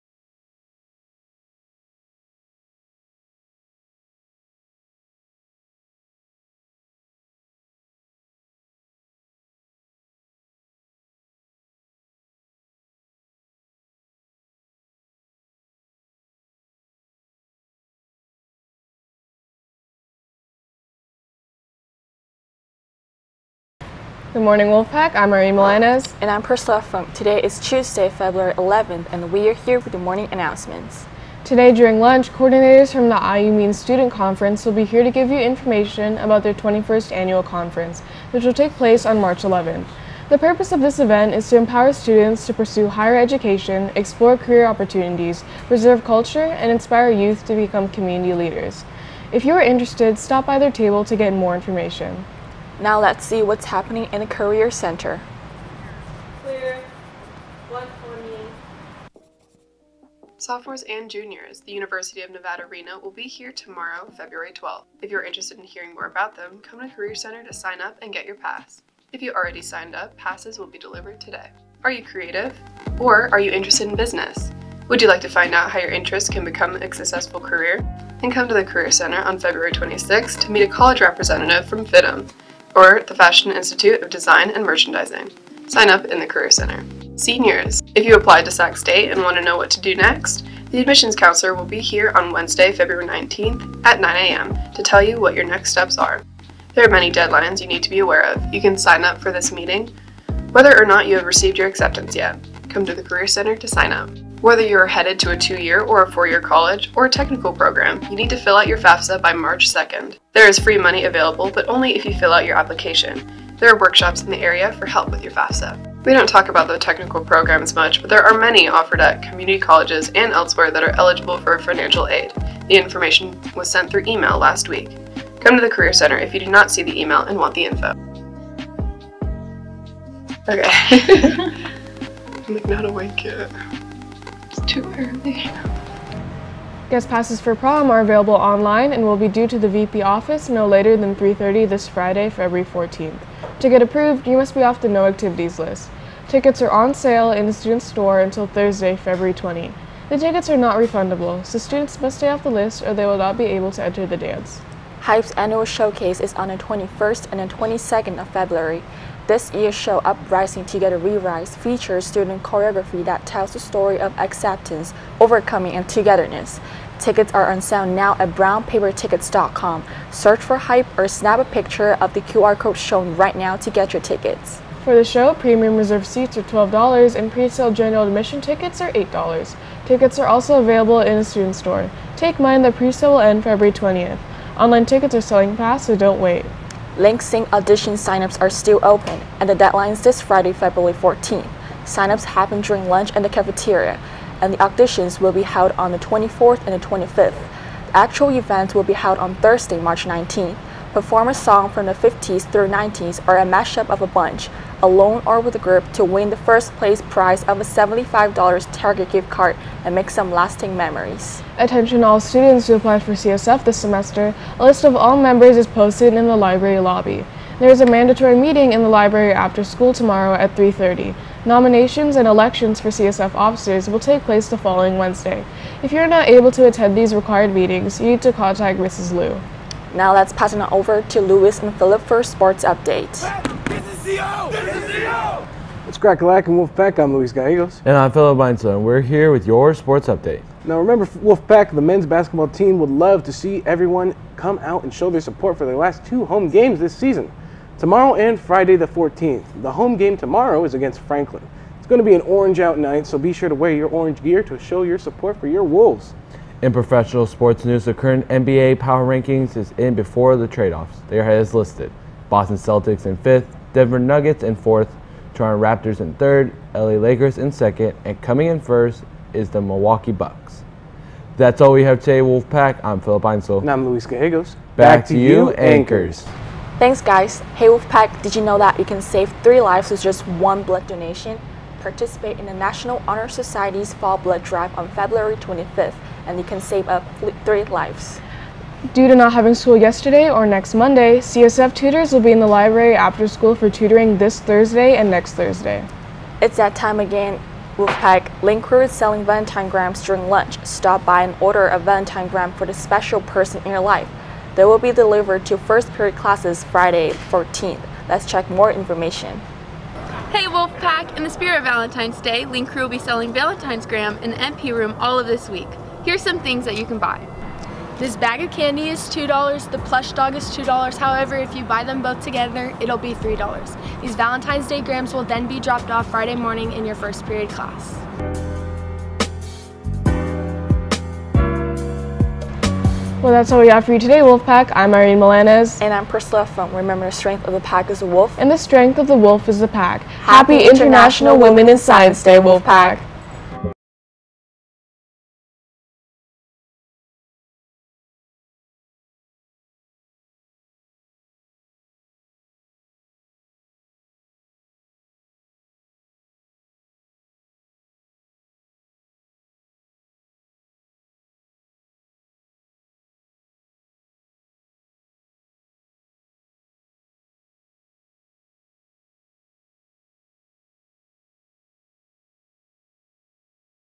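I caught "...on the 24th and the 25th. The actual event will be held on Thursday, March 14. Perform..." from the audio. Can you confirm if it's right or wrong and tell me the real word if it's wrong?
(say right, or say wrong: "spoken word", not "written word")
wrong: "19", not "14".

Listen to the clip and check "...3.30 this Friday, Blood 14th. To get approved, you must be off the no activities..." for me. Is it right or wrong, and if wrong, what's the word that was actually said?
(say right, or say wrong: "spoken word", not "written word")
wrong: "February", not "Blood".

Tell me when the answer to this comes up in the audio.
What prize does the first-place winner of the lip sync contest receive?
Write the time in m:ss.
3:27.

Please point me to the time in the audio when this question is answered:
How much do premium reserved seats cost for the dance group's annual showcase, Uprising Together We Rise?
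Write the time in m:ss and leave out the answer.
2:56.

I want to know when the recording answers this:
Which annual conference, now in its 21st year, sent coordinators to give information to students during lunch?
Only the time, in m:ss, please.
0:33.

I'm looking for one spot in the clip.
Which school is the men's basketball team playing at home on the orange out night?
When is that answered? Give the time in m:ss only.
4:10.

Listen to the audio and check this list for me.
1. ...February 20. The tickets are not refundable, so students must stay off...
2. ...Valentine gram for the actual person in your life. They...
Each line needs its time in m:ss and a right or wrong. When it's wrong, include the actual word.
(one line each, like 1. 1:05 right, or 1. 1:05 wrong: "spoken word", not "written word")
1. 2:28 right
2. 5:01 wrong: "special", not "actual".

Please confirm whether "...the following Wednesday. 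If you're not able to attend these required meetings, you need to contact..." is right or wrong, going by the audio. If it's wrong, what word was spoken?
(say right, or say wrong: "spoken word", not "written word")
right.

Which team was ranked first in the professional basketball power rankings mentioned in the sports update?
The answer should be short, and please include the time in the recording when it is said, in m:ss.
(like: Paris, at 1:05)
Milwaukee Bucks, at 4:29.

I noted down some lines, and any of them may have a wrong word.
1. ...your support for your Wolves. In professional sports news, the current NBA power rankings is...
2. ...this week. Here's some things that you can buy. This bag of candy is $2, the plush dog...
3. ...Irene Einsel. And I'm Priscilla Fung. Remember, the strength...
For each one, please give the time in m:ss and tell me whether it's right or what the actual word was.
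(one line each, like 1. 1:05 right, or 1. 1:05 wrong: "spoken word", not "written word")
1. 4:14 right
2. 5:15 right
3. 5:34 wrong: "Milanes", not "Einsel".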